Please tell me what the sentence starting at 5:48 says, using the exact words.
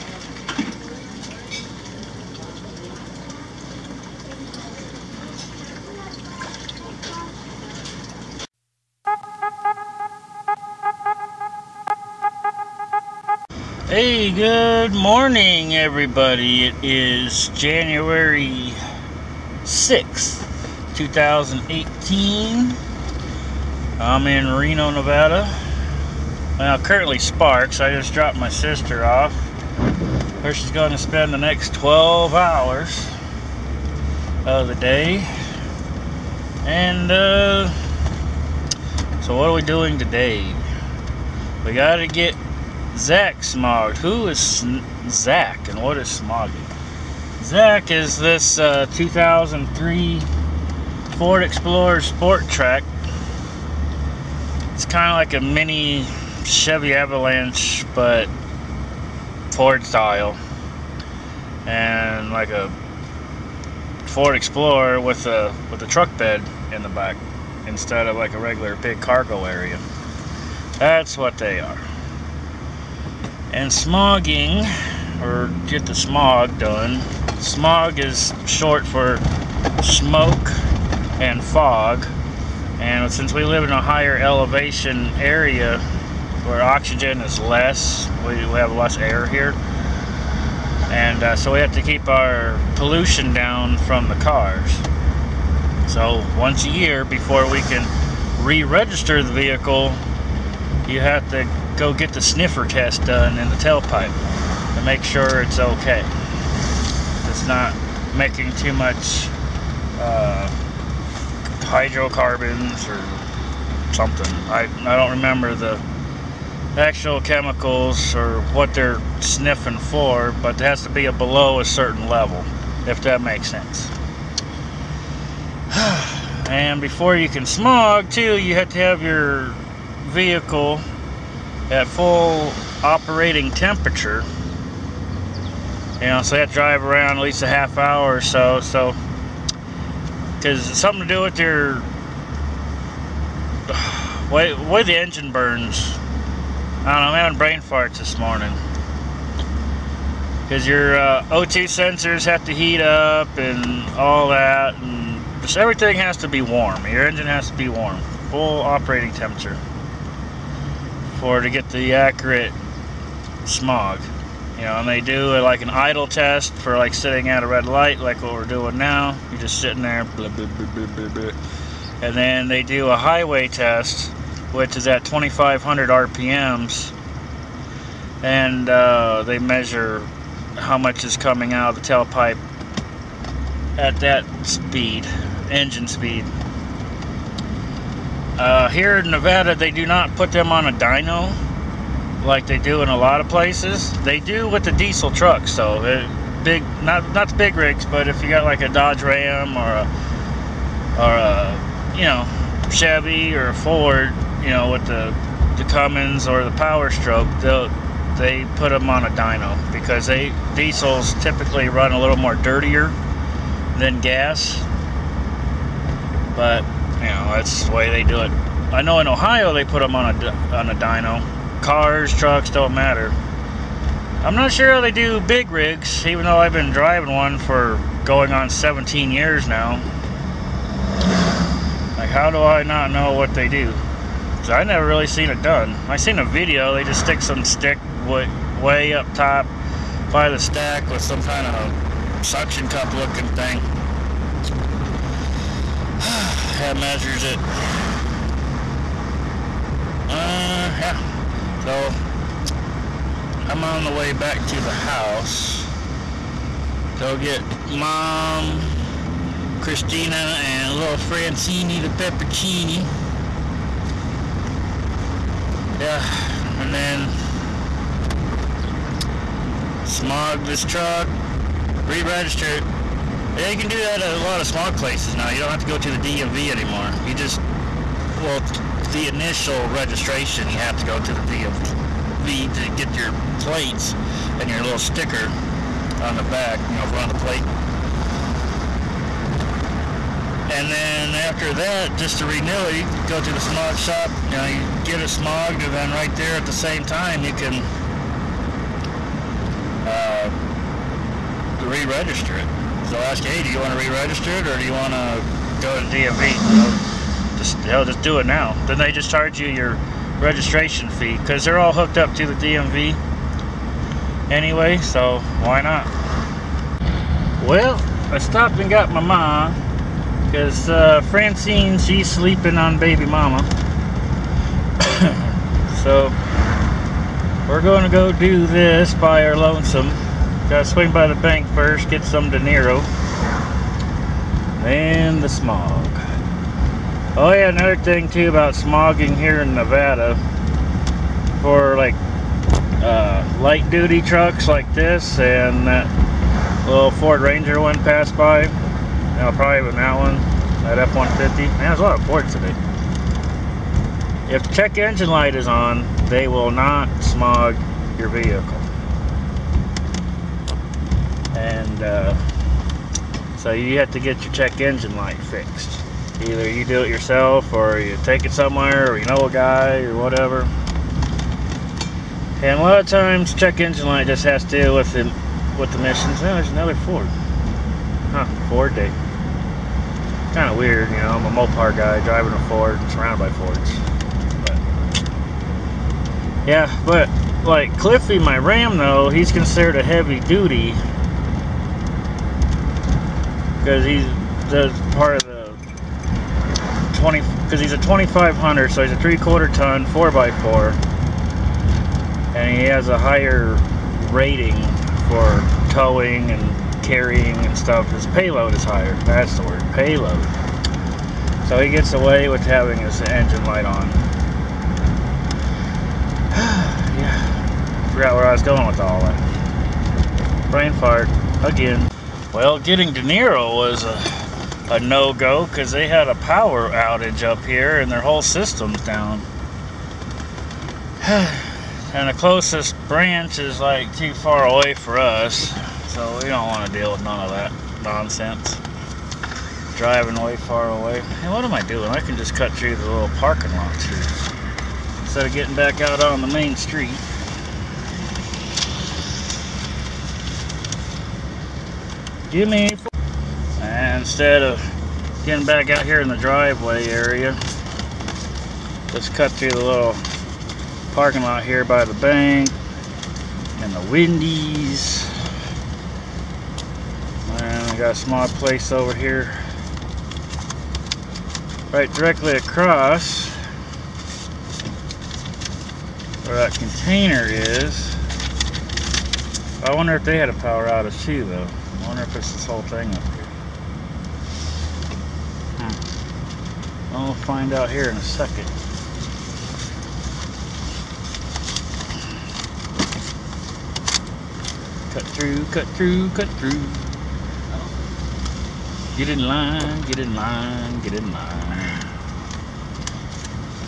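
You probably with that one, that F-150.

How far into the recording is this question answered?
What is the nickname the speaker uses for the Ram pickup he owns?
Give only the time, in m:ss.
6:27.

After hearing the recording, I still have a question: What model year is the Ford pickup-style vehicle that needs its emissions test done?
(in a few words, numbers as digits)
2003.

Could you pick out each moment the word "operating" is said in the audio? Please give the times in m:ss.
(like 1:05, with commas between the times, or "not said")
2:12, 2:38.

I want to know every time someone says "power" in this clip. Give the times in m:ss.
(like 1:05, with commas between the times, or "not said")
3:26, 7:06, 8:00.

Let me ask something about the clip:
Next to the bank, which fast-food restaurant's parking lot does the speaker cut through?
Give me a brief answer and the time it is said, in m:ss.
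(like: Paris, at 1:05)
Wendy's, at 7:43.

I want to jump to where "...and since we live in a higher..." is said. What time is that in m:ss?
1:22.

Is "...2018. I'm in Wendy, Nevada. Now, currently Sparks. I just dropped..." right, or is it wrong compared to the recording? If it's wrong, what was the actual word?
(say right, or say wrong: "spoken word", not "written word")
wrong: "Reno", not "Wendy".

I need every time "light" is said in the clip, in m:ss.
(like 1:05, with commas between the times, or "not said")
2:47, 5:43, 5:55, 6:04, 6:13, 6:53.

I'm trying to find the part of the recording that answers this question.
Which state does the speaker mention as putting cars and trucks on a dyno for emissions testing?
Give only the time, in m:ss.
3:39.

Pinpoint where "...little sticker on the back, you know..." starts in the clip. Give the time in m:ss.
4:44.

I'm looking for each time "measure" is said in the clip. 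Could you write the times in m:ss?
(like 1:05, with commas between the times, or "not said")
2:59, 4:06.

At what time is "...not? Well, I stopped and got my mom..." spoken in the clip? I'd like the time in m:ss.
5:15.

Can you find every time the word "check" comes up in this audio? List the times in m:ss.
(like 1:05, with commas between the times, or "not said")
5:54, 6:04, 6:13.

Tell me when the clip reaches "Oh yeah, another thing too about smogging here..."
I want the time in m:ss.
5:37.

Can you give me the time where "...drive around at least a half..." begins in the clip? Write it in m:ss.
2:16.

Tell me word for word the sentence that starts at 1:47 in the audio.
It's not making too much uh, hydrocarbons or something.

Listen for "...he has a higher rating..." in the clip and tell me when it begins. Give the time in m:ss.
6:42.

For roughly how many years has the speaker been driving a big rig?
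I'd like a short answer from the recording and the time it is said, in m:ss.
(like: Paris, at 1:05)
17 years, at 3:48.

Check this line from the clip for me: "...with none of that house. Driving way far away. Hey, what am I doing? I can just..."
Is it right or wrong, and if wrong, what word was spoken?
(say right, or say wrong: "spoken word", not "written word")
wrong: "nonsense", not "house".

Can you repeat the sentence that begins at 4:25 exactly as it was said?
Yeah, and then smog this truck, re-register it, yeah, you can do that at a lot of small places now.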